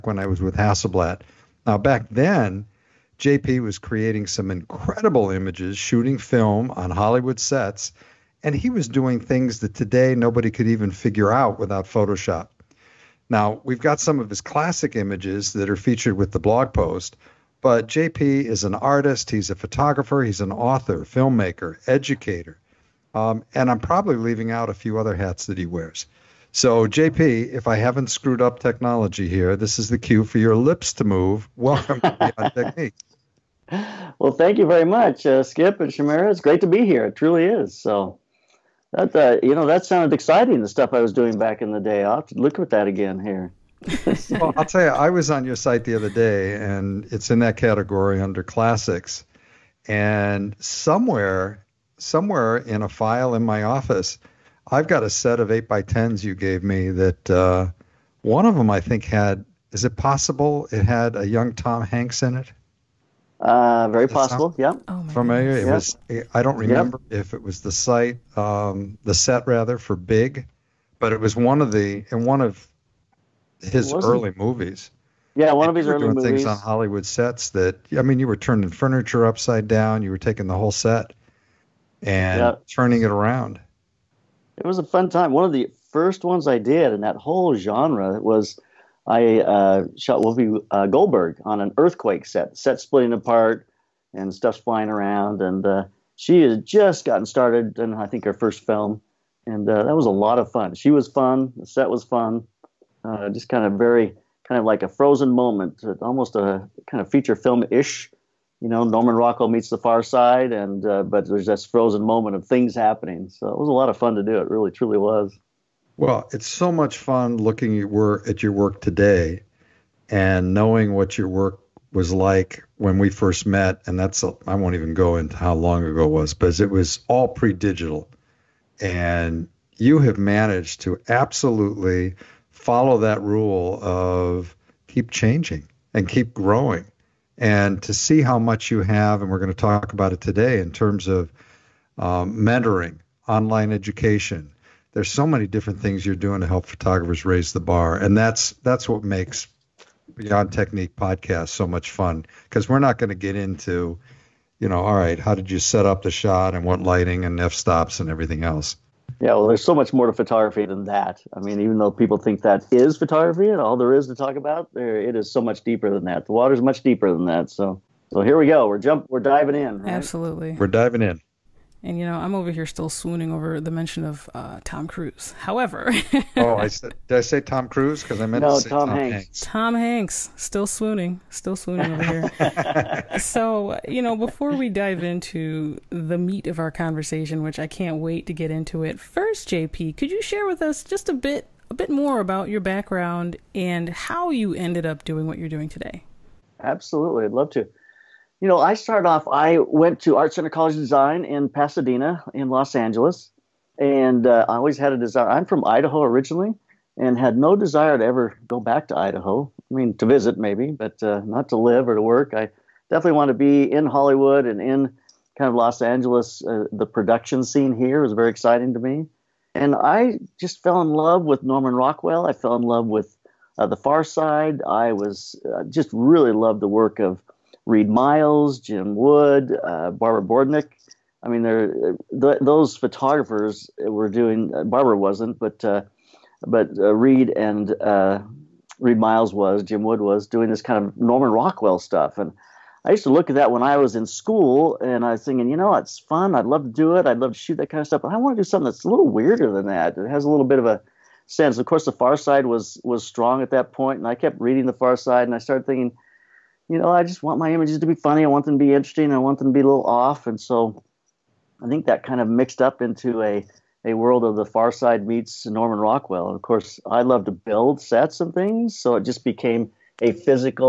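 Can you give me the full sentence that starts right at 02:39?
Yeah, well, there's so much more to photography than that.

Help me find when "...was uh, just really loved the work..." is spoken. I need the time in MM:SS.
03:44.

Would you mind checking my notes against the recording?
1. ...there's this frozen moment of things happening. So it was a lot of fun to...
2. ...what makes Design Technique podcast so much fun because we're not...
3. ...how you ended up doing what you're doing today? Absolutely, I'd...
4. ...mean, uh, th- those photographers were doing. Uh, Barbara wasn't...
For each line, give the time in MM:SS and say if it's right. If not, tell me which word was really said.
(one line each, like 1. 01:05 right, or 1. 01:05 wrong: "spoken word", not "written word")
1. 01:51 right
2. 02:28 wrong: "Beyond", not "Design"
3. 03:13 right
4. 03:51 right.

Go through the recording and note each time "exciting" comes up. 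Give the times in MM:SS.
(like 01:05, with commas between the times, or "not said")
00:40, 03:38.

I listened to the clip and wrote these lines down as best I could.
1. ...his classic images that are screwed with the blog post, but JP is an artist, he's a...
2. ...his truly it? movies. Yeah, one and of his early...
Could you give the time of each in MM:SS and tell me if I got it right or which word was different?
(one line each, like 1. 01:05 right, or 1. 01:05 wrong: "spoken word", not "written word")
1. 00:14 wrong: "featured", not "screwed"
2. 01:13 wrong: "early", not "truly".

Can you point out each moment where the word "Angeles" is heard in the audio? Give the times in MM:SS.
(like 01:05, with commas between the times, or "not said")
03:22, 03:35.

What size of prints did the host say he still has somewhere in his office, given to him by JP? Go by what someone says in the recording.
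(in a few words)
8x10.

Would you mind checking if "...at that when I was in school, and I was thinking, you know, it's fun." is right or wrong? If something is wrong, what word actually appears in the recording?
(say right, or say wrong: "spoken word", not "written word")
right.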